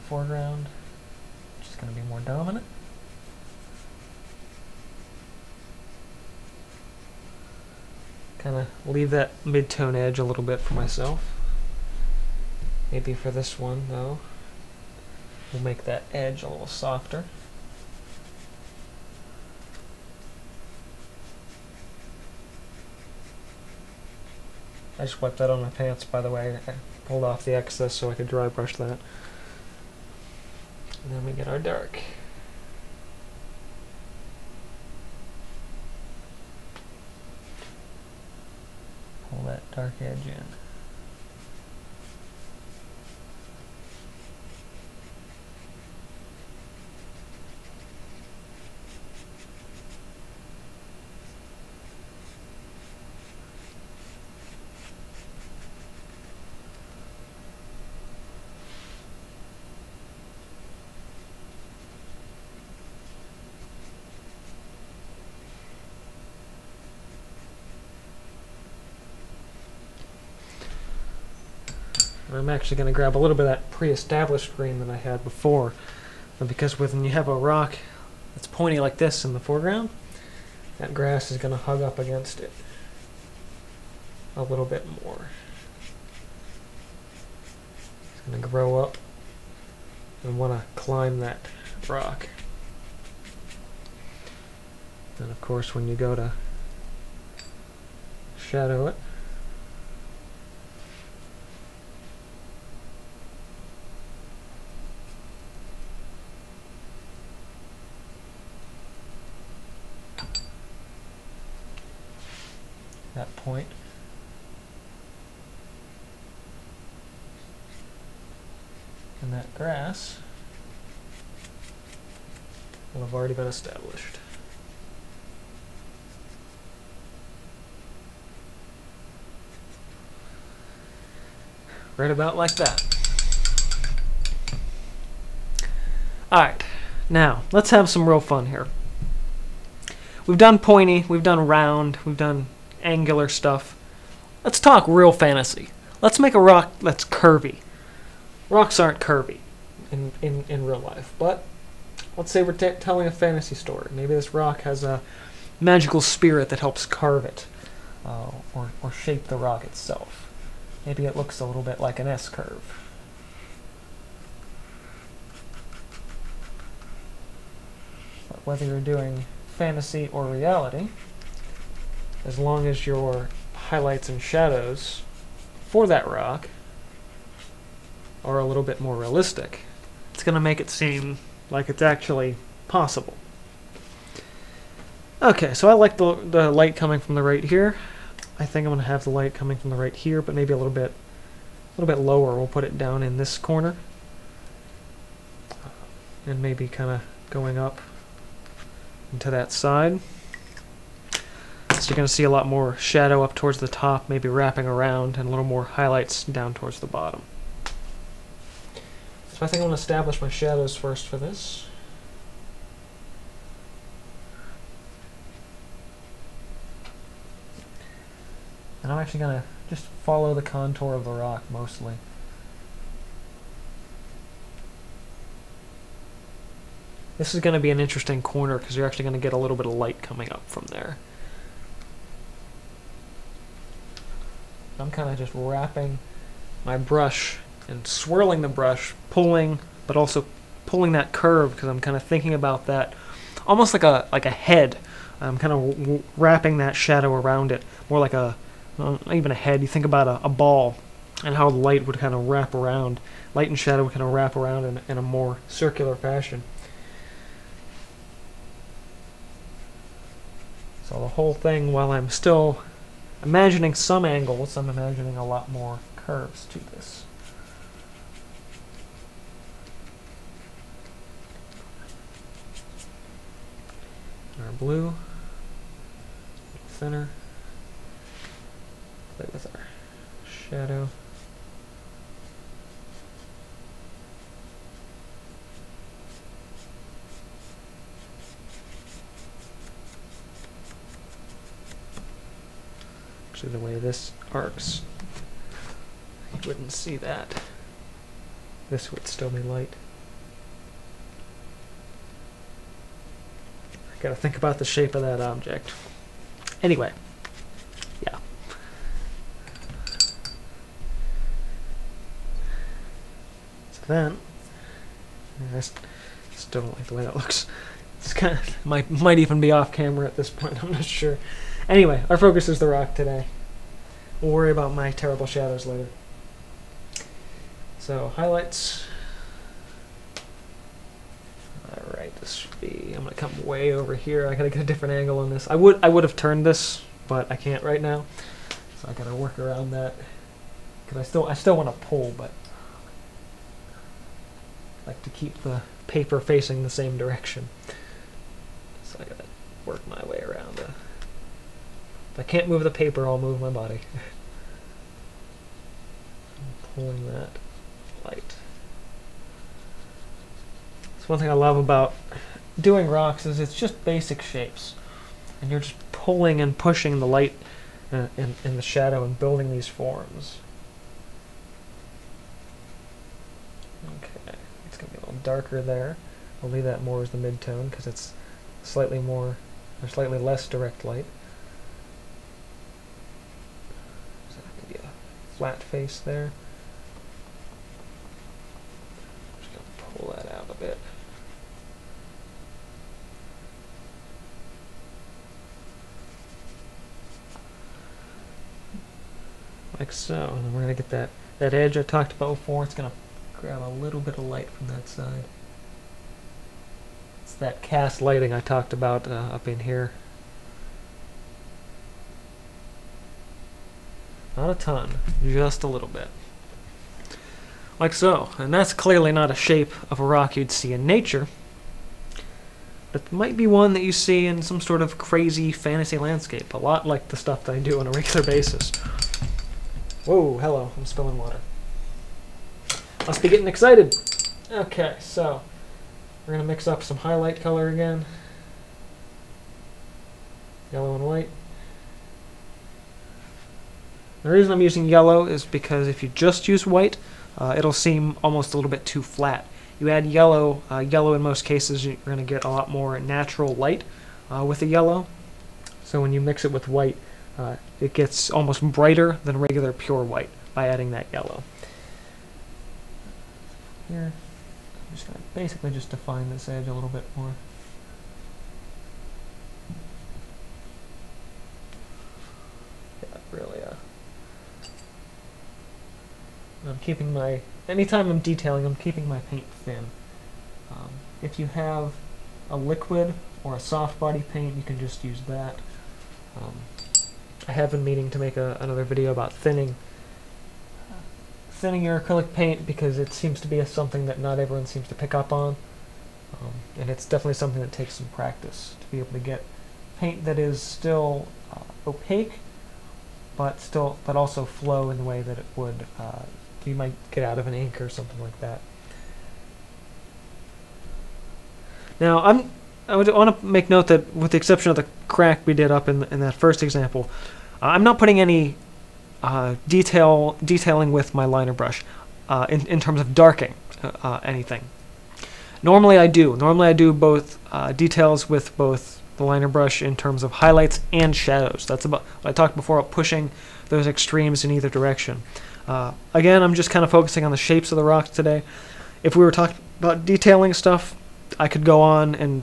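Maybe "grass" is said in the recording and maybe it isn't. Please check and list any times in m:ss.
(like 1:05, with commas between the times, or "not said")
1:20, 1:59.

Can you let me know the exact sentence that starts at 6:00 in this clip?
It's one thing I love about doing rocks is it's just basic shapes.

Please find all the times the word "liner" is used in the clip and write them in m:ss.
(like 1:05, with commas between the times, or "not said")
8:41, 8:49.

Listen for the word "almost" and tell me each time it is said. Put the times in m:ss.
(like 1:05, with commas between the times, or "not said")
4:03, 7:28, 7:38.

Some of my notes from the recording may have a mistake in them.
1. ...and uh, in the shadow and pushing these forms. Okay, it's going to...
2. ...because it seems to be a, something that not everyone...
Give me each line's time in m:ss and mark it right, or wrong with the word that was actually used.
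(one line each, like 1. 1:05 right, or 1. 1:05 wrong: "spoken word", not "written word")
1. 6:07 wrong: "building", not "pushing"
2. 8:12 right.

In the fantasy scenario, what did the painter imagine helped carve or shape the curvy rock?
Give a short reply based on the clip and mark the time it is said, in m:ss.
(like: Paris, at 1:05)
A magical spirit, at 2:35.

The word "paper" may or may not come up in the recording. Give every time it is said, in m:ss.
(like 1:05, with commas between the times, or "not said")
5:45, 5:52.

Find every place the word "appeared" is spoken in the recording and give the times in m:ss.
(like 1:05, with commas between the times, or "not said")
not said.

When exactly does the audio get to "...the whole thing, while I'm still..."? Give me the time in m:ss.
4:20.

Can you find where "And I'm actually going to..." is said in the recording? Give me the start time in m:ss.
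3:38.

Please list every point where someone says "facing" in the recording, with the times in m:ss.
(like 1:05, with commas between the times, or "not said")
5:46.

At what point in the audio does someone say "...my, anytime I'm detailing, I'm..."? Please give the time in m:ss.
7:57.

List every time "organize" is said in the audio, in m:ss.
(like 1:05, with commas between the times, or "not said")
not said.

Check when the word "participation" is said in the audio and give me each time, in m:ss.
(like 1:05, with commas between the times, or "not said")
not said.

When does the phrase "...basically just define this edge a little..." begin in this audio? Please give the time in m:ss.
7:45.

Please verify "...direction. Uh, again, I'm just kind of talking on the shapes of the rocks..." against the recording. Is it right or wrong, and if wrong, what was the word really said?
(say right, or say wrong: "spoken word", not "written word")
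wrong: "focusing", not "talking".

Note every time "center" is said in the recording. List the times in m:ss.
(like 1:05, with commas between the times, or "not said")
4:36.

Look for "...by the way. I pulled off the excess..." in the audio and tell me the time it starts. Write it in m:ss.
0:26.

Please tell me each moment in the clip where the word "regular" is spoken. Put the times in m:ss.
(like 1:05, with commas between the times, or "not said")
7:07, 7:39.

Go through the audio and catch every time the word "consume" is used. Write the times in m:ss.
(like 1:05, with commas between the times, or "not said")
not said.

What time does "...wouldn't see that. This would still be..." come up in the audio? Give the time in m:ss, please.
4:56.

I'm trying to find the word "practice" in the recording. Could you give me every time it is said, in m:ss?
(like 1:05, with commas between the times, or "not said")
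8:18.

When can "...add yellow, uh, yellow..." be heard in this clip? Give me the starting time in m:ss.
7:29.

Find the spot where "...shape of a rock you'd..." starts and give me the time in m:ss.
6:59.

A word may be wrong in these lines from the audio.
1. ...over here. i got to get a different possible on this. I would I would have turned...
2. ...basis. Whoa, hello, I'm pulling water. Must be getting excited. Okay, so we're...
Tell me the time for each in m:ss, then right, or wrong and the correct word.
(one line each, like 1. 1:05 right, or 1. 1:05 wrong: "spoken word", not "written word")
1. 5:33 wrong: "angle", not "possible"
2. 7:08 wrong: "spilling", not "pulling".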